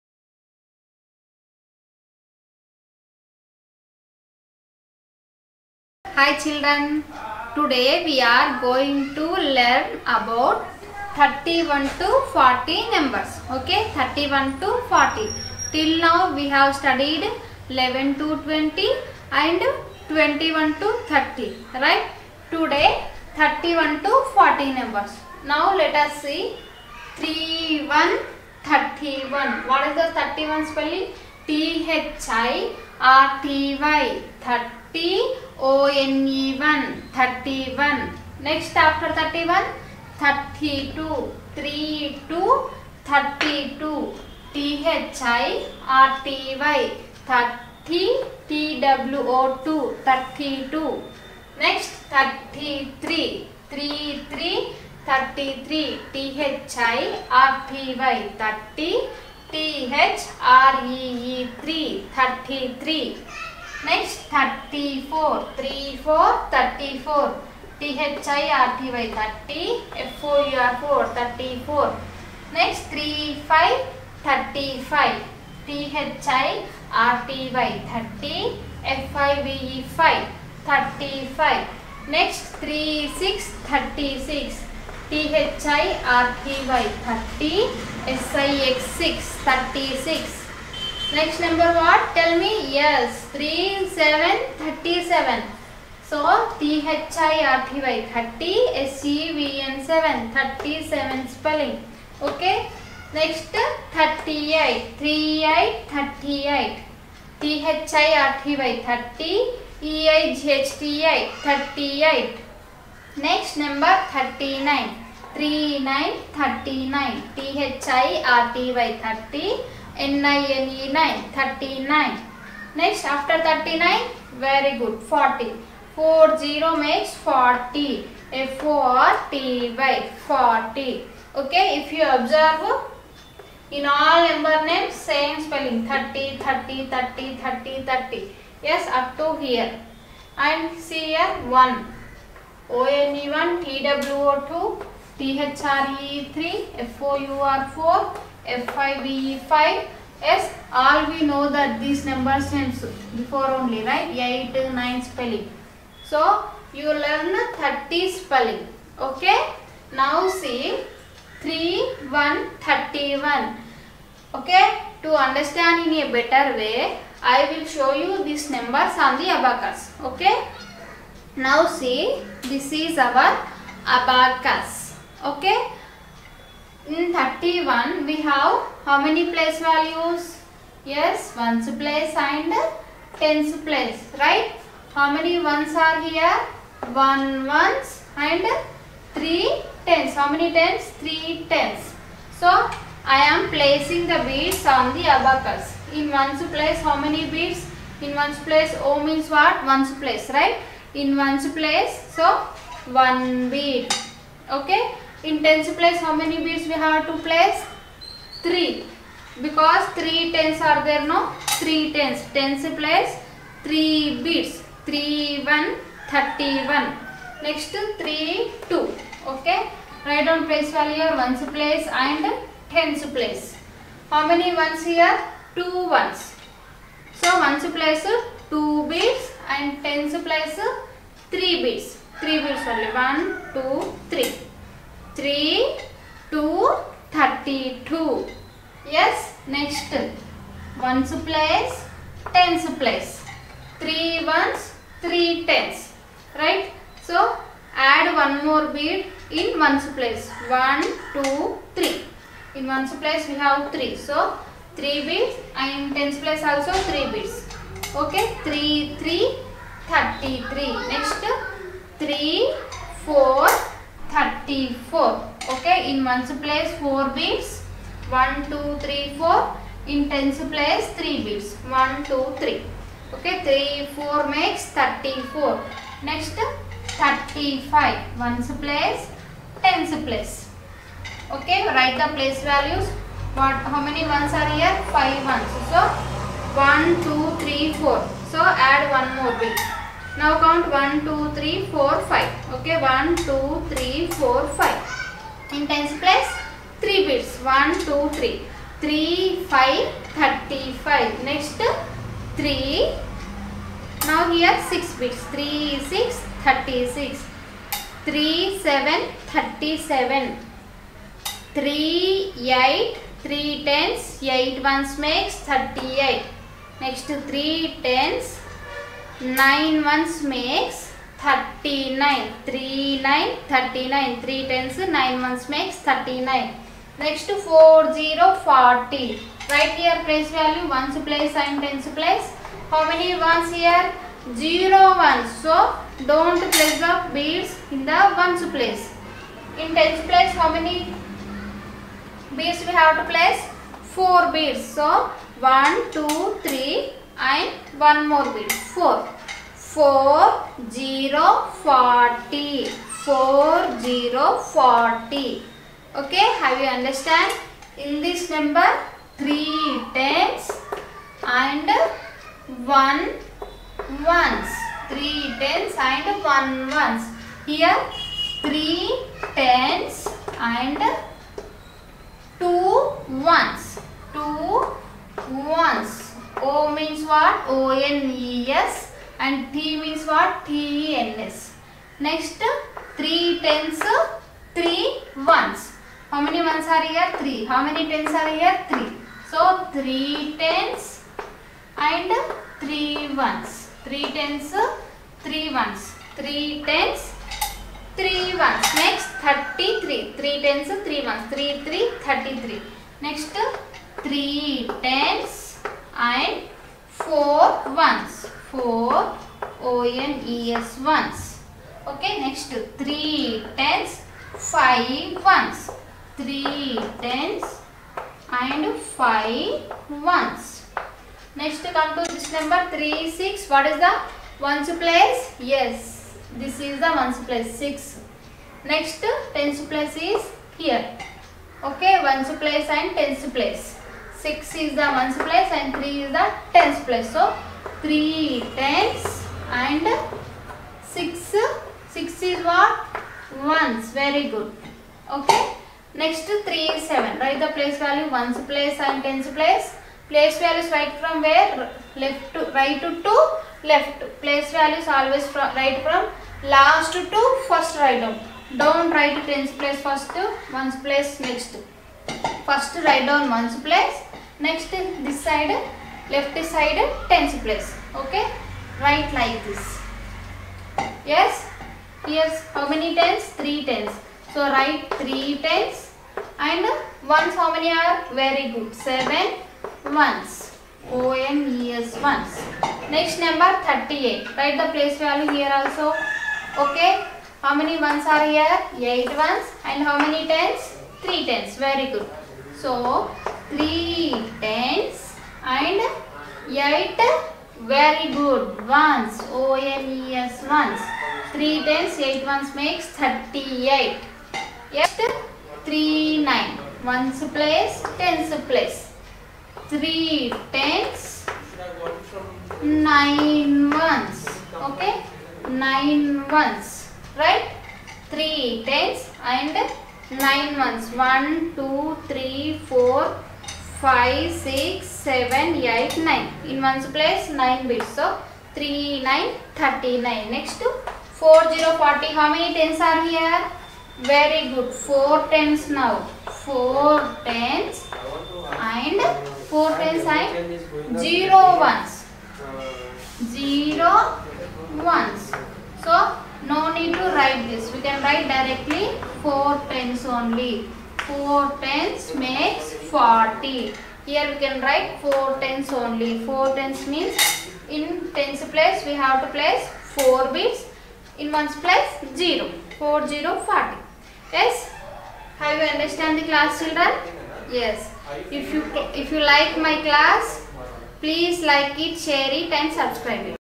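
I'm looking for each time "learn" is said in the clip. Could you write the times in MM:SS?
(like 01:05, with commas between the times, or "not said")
00:09, 02:36.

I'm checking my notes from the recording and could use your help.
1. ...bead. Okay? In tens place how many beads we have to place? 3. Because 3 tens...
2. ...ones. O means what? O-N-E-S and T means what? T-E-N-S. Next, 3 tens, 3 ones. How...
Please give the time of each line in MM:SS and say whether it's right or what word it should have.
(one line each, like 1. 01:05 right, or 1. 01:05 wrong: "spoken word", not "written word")
1. 03:23 right
2. 06:15 right.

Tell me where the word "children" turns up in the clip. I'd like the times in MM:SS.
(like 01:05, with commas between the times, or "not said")
00:06, 09:26.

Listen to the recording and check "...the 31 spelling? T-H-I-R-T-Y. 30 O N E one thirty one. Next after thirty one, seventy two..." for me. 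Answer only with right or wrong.
wrong.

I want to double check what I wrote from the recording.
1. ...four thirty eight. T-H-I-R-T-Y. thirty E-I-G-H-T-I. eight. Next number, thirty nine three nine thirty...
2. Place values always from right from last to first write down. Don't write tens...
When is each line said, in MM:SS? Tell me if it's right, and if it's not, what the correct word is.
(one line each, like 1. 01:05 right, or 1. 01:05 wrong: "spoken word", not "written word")
1. 01:45 wrong: "eight", not "four"
2. 07:34 right.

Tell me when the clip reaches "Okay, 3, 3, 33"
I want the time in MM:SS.
04:17.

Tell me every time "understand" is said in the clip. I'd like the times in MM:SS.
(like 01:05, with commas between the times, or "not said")
02:45, 05:56, 09:25.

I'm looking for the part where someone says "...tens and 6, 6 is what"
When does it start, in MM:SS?
07:18.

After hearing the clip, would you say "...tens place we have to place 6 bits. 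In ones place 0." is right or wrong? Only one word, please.
wrong.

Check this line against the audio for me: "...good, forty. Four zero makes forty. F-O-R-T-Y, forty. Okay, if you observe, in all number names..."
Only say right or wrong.
right.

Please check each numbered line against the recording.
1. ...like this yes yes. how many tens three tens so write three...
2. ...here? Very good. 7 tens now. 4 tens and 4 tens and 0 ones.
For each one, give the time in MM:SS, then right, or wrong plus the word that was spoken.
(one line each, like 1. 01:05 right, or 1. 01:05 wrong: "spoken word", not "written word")
1. 07:49 right
2. 08:53 wrong: "4", not "7".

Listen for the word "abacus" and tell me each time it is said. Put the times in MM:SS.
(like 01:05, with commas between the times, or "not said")
02:49, 02:53, 03:15.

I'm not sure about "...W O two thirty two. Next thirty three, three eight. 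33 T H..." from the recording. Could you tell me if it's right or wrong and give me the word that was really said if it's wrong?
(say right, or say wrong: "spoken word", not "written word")
wrong: "three", not "eight".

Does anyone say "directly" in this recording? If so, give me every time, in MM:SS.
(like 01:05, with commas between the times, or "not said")
09:08.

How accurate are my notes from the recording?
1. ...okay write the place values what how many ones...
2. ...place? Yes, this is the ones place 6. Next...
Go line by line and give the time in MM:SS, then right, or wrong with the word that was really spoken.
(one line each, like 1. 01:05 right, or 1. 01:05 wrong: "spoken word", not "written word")
1. 04:41 right
2. 07:04 right.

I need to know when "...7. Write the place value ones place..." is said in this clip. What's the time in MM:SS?
07:26.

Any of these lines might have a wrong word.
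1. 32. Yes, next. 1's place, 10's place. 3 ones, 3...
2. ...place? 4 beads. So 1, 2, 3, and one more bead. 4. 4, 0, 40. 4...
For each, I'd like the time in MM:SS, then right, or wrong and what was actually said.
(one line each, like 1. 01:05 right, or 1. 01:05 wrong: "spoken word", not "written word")
1. 03:58 right
2. 05:43 right.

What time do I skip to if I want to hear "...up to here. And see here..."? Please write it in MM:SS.
02:18.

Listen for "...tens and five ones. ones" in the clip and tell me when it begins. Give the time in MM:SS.
06:57.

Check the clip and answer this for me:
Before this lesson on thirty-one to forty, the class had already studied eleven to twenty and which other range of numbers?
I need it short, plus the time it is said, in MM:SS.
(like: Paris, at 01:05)
21 to 30, at 00:20.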